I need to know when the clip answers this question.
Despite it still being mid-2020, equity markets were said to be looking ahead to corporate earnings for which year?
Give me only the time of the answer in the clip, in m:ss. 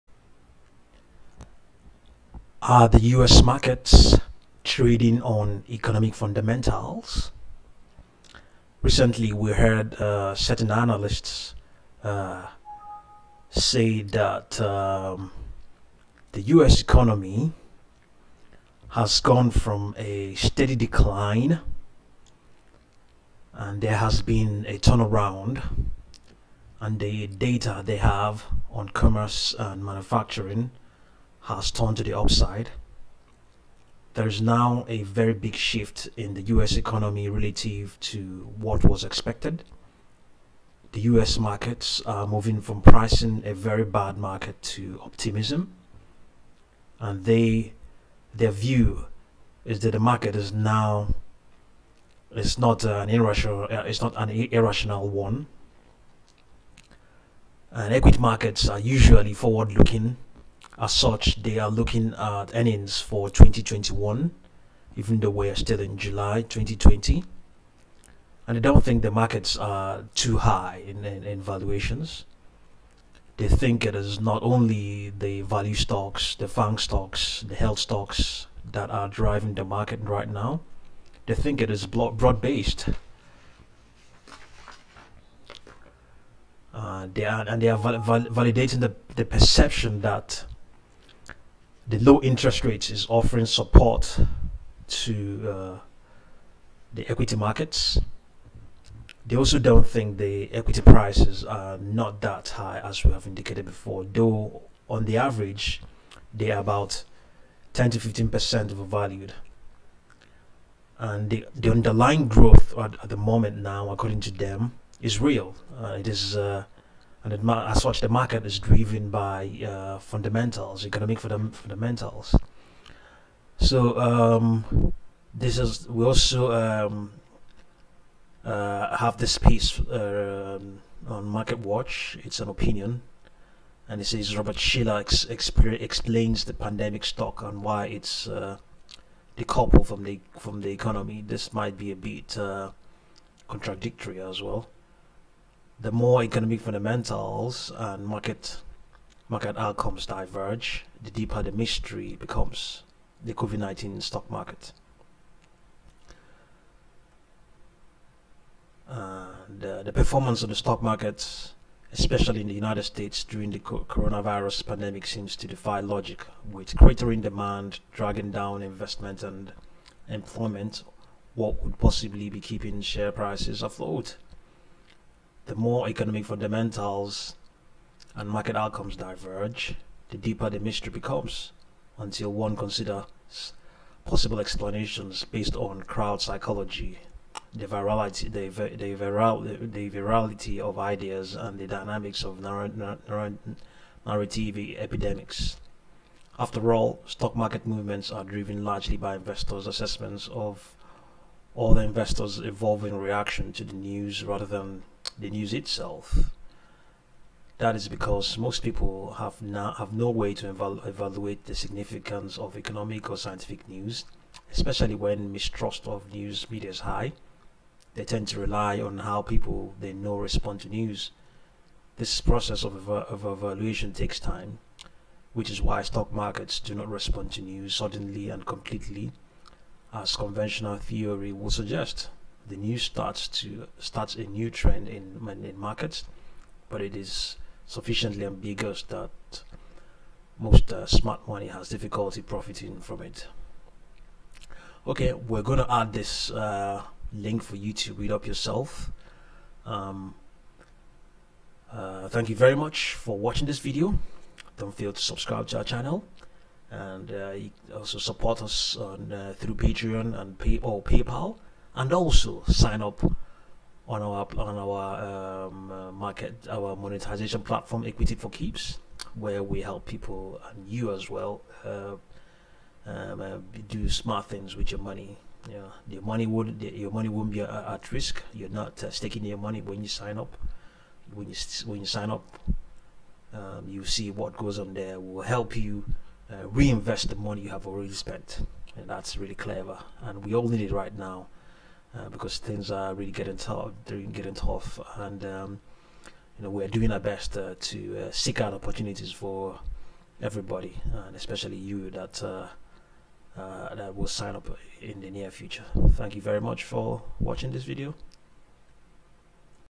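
1:03.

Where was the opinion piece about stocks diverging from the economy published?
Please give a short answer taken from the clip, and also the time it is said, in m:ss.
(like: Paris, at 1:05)
Market Watch, at 2:11.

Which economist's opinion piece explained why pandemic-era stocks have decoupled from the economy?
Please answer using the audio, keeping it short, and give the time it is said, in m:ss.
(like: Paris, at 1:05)
Robert Shiller, at 2:14.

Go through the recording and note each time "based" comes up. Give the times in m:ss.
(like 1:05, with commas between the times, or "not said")
1:22, 3:05.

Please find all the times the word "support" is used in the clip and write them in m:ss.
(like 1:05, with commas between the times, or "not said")
1:33, 4:17.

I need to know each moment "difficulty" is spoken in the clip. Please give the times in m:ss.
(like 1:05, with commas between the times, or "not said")
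4:01.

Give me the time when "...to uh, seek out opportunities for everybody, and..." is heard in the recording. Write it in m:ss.
4:57.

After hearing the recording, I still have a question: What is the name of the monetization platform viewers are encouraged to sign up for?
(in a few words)
equity for keeps.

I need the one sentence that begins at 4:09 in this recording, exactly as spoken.
Um, uh, thank you very much for watching this video.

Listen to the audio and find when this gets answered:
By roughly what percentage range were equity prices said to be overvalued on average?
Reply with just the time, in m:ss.
1:47.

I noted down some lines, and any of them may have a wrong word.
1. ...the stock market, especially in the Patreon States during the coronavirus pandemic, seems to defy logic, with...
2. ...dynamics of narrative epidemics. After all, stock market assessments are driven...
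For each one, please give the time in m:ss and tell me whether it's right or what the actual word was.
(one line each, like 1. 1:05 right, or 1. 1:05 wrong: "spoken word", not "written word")
1. 2:40 wrong: "United", not "Patreon"
2. 3:11 wrong: "movements", not "assessments".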